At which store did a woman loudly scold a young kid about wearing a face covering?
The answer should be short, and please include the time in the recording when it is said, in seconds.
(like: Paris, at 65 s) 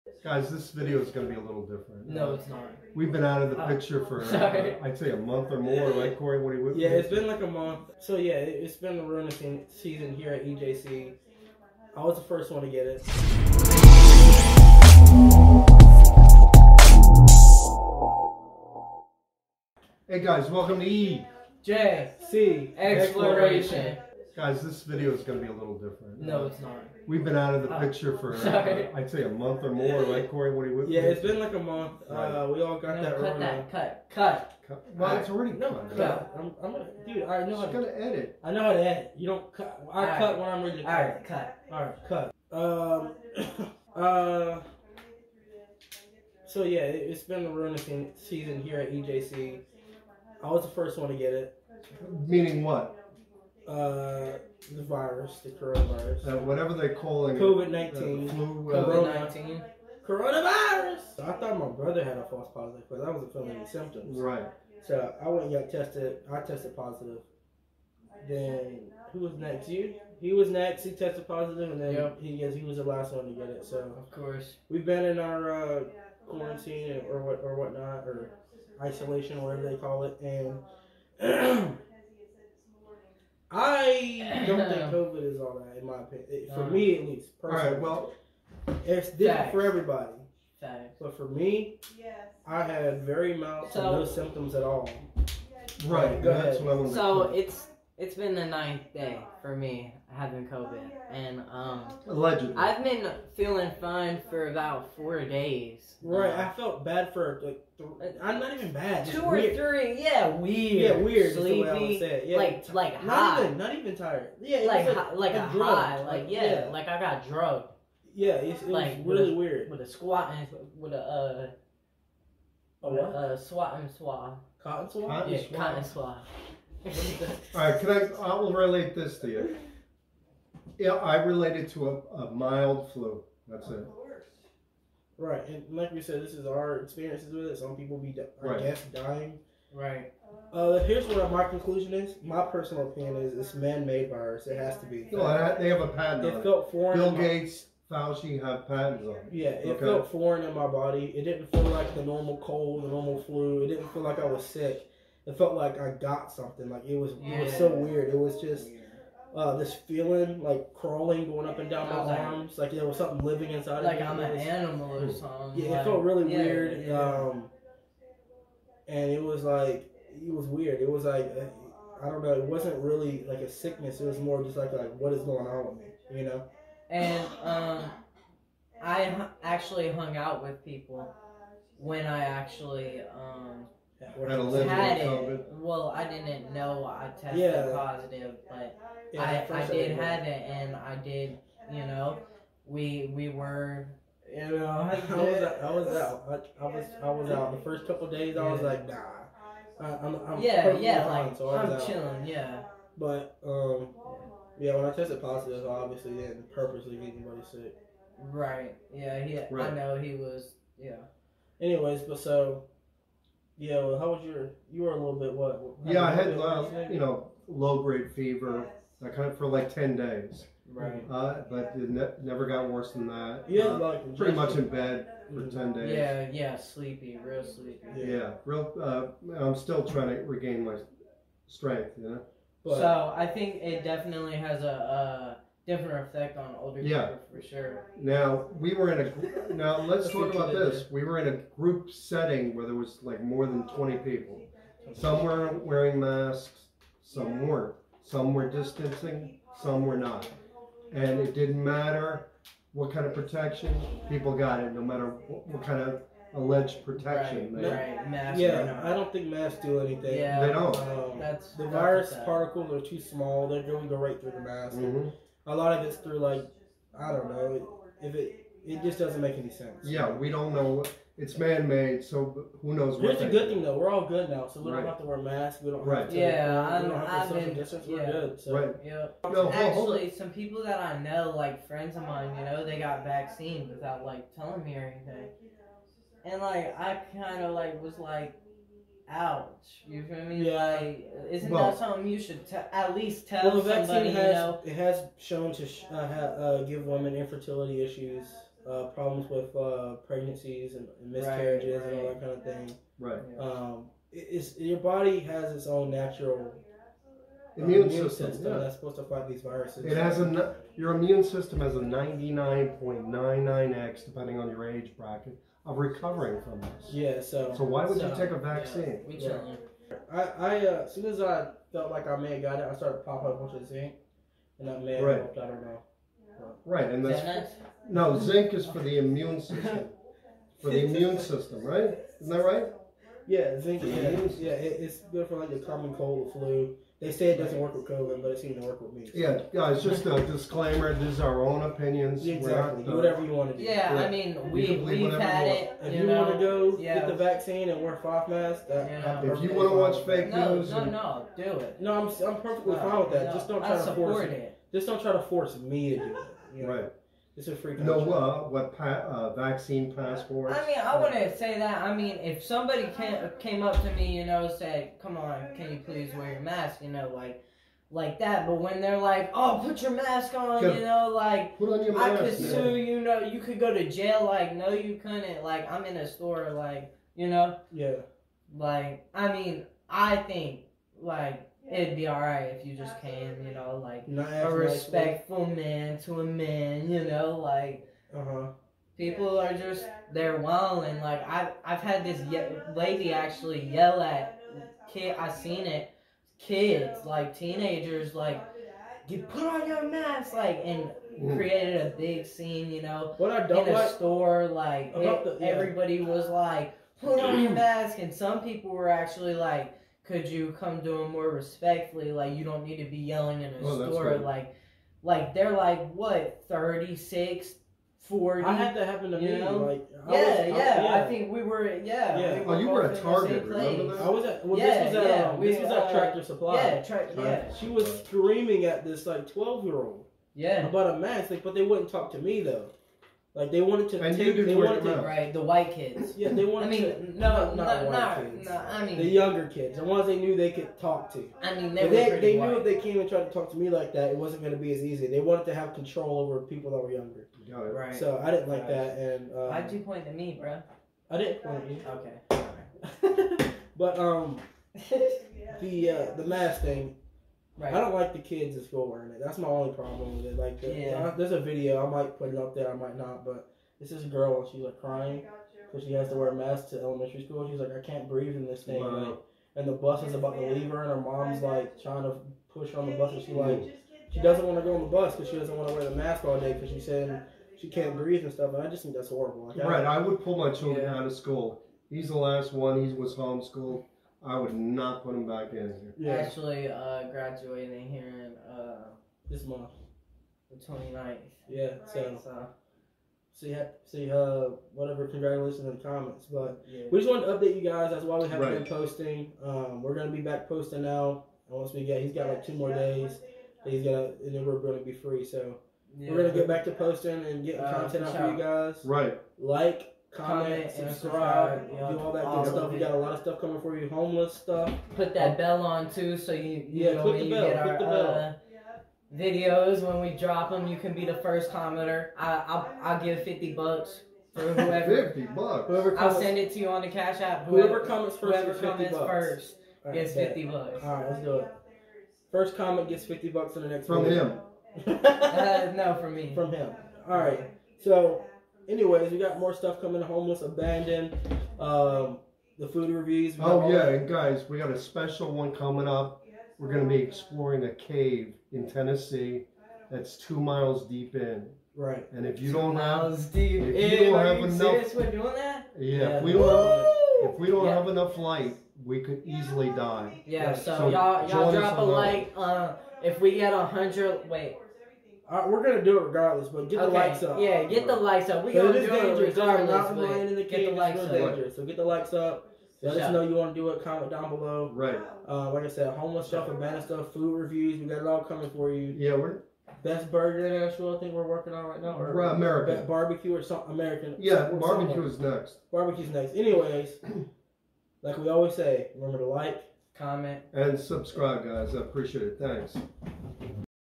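Tractor Supply, at 425 s.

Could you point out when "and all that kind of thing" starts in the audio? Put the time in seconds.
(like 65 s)
301 s.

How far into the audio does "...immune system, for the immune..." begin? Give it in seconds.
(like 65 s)
328 s.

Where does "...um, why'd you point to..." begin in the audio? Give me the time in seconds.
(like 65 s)
449 s.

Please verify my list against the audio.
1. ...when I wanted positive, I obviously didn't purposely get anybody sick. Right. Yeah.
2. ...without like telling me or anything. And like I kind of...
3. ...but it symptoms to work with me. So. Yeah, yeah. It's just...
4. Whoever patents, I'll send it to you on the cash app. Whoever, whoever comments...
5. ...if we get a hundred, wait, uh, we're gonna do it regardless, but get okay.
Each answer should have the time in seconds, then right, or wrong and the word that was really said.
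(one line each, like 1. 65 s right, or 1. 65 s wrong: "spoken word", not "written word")
1. 204 s wrong: "tested", not "wanted"
2. 283 s right
3. 338 s wrong: "seems", not "symptoms"
4. 525 s wrong: "comments", not "patents"
5. 563 s right.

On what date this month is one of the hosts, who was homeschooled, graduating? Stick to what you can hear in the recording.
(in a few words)
29th.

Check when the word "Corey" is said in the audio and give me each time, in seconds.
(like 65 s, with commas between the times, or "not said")
6 s, 30 s.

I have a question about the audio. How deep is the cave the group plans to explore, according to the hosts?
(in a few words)
2 miles.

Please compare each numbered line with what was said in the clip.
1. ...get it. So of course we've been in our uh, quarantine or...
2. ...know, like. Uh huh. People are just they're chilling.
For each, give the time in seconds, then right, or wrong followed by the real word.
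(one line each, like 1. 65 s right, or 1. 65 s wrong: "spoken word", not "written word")
1. 73 s right
2. 387 s wrong: "wilding", not "chilling".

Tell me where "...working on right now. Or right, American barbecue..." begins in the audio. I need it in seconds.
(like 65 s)
581 s.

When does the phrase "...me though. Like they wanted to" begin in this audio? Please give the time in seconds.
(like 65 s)
432 s.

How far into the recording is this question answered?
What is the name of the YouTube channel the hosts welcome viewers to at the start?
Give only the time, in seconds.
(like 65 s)
20 s.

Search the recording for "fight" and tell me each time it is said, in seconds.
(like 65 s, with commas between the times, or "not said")
309 s.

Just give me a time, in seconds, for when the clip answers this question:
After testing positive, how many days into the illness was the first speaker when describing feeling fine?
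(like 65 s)
98 s.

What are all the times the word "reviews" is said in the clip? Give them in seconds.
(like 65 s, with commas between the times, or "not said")
542 s, 577 s.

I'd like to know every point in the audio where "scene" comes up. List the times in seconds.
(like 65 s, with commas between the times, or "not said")
402 s.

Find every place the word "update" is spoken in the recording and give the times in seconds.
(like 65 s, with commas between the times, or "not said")
497 s.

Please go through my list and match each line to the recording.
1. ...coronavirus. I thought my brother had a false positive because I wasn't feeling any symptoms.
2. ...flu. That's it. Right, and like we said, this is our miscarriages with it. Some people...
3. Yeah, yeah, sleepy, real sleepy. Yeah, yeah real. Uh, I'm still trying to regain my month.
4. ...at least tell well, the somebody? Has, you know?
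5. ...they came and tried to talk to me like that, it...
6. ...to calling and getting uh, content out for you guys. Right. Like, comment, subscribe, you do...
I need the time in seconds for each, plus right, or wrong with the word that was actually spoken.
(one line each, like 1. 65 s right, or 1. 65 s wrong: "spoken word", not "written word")
1. 60 s right
2. 132 s wrong: "experiences", not "miscarriages"
3. 225 s wrong: "strength", not "month"
4. 292 s right
5. 442 s right
6. 506 s wrong: "posting", not "calling".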